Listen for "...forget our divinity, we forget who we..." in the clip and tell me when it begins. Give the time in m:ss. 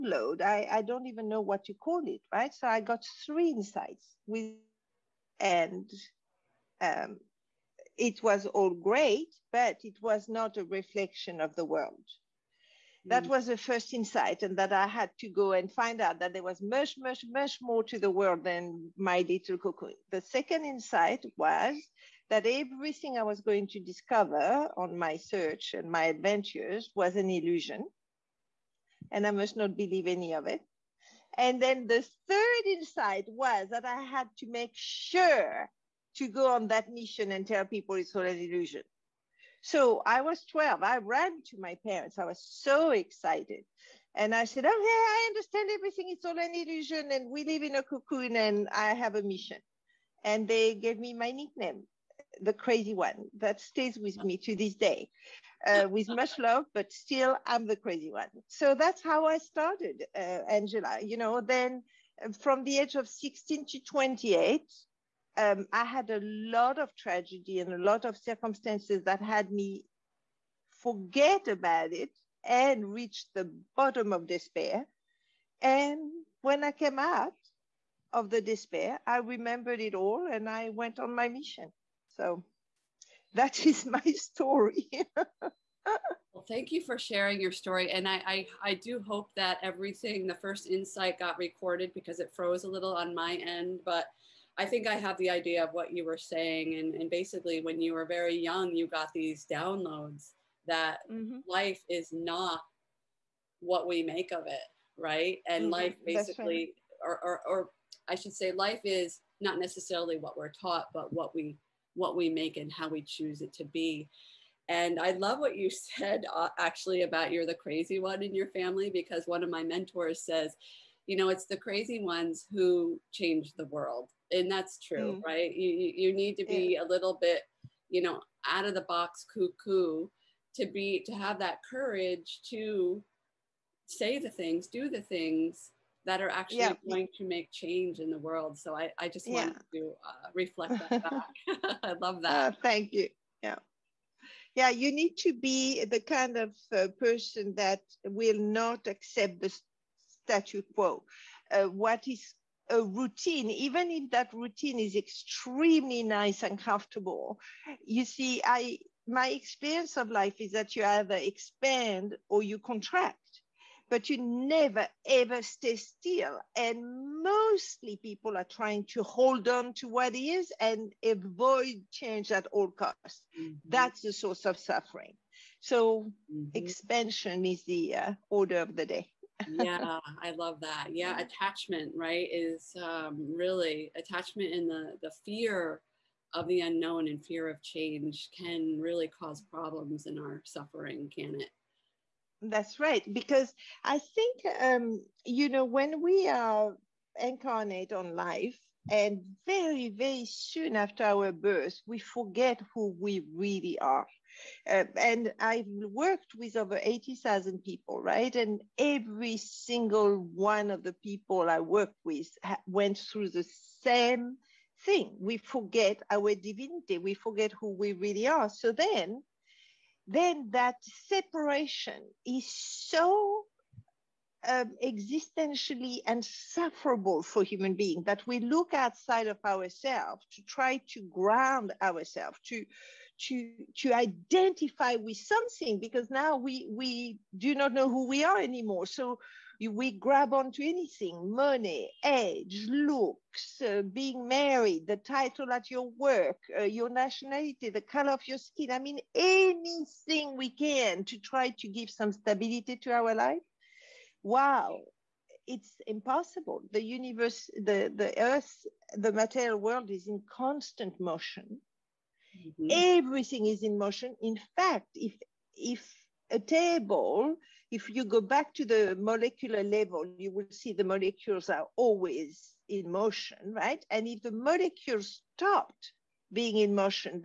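3:35.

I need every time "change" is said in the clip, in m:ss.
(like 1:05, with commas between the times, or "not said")
2:03, 2:17, 2:51, 3:07.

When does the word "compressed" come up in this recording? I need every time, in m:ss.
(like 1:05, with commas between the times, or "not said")
not said.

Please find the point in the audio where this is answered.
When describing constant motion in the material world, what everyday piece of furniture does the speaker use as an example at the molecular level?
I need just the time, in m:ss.
4:26.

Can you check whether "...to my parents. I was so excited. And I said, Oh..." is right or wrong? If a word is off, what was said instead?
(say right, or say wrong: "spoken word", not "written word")
right.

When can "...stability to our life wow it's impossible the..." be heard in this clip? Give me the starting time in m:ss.
4:12.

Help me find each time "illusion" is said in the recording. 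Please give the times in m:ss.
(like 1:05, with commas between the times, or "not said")
0:27, 0:38, 0:46.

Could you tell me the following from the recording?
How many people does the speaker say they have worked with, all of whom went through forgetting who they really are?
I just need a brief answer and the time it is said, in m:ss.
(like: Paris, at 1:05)
80,000, at 3:26.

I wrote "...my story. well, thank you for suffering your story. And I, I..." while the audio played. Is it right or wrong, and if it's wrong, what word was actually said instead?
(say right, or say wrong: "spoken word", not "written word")
wrong: "sharing", not "suffering".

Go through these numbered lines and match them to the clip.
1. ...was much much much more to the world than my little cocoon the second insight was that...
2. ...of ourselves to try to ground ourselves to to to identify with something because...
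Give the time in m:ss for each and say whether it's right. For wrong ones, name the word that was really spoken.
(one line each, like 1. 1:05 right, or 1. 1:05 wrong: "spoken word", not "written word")
1. 0:16 right
2. 3:49 right.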